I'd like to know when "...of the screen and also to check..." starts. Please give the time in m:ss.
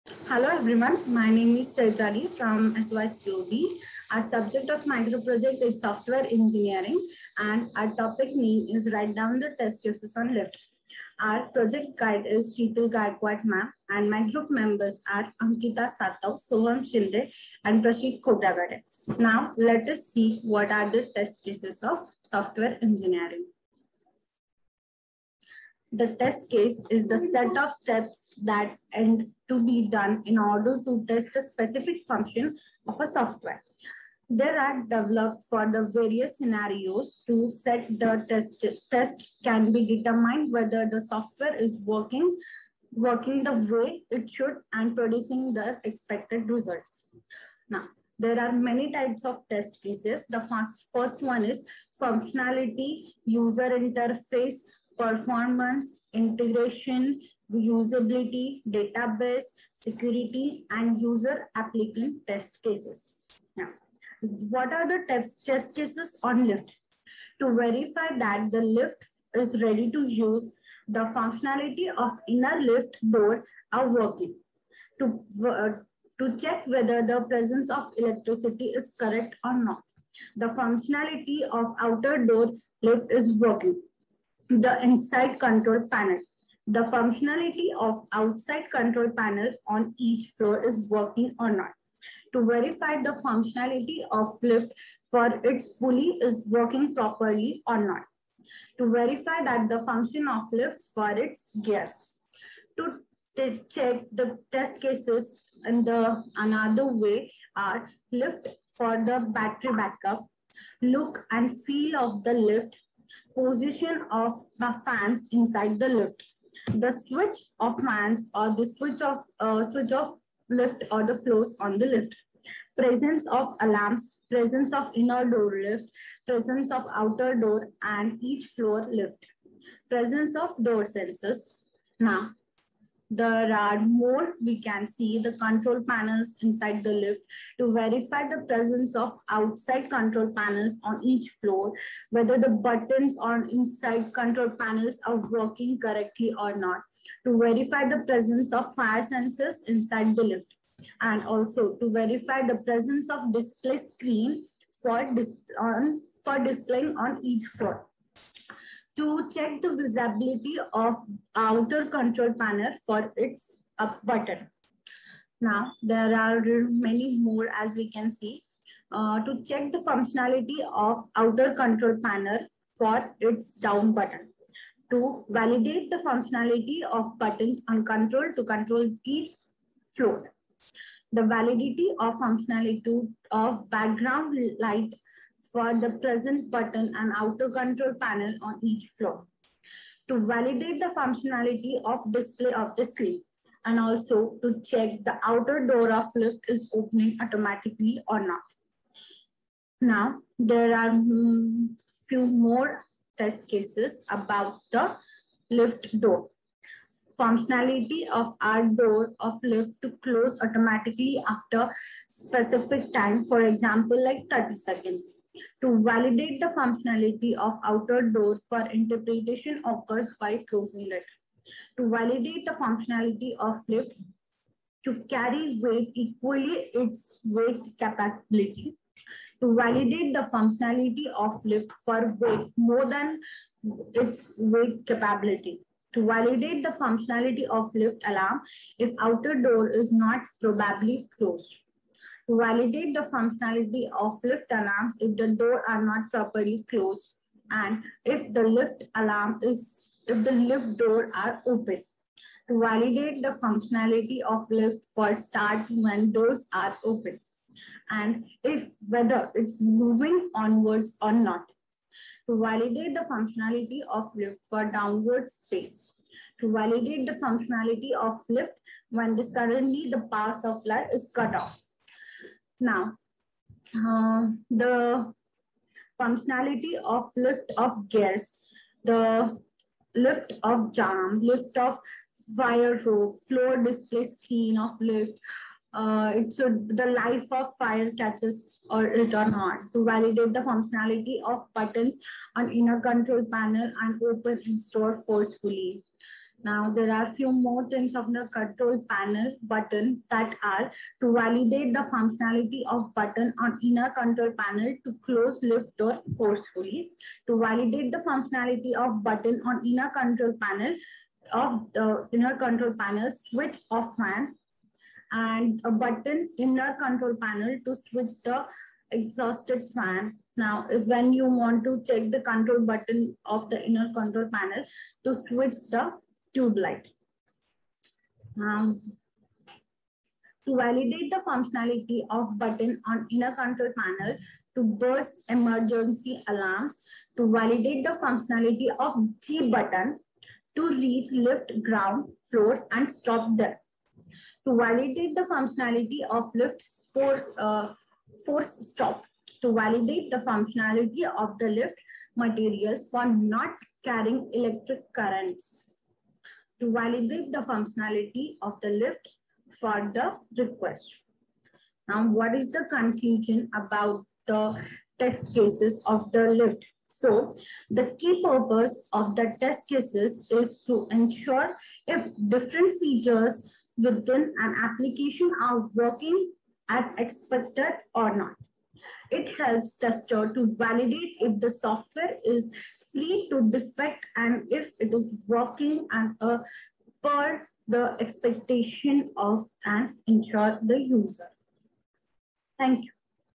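3:12.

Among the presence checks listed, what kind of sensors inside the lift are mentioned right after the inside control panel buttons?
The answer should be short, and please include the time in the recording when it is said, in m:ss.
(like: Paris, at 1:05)
Fire sensors, at 2:28.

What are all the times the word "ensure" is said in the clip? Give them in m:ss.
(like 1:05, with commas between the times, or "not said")
6:10, 6:30.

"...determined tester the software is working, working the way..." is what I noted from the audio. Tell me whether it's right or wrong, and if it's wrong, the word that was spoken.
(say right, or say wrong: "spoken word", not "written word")
wrong: "whether", not "tester".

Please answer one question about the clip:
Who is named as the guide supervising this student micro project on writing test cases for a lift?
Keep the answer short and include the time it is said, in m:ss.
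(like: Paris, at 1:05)
Sheetal Gaikwad, at 0:12.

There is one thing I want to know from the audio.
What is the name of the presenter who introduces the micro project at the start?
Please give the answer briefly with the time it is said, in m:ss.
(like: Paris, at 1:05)
Chaitali, at 0:01.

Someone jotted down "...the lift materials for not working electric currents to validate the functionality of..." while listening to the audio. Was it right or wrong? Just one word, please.
wrong.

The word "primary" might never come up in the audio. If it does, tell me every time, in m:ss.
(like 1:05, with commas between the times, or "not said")
not said.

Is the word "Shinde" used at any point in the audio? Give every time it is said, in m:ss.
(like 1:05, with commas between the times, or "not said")
0:16.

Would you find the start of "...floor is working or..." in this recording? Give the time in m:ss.
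1:30.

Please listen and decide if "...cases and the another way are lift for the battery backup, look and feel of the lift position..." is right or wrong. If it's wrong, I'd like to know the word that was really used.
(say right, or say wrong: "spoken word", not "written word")
right.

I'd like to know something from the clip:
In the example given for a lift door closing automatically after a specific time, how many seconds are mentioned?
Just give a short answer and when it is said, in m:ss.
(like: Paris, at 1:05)
30 seconds, at 3:34.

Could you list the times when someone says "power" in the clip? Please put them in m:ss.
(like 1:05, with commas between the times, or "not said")
4:30.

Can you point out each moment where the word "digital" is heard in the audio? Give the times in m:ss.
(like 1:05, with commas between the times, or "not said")
not said.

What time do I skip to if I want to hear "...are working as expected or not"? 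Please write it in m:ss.
6:15.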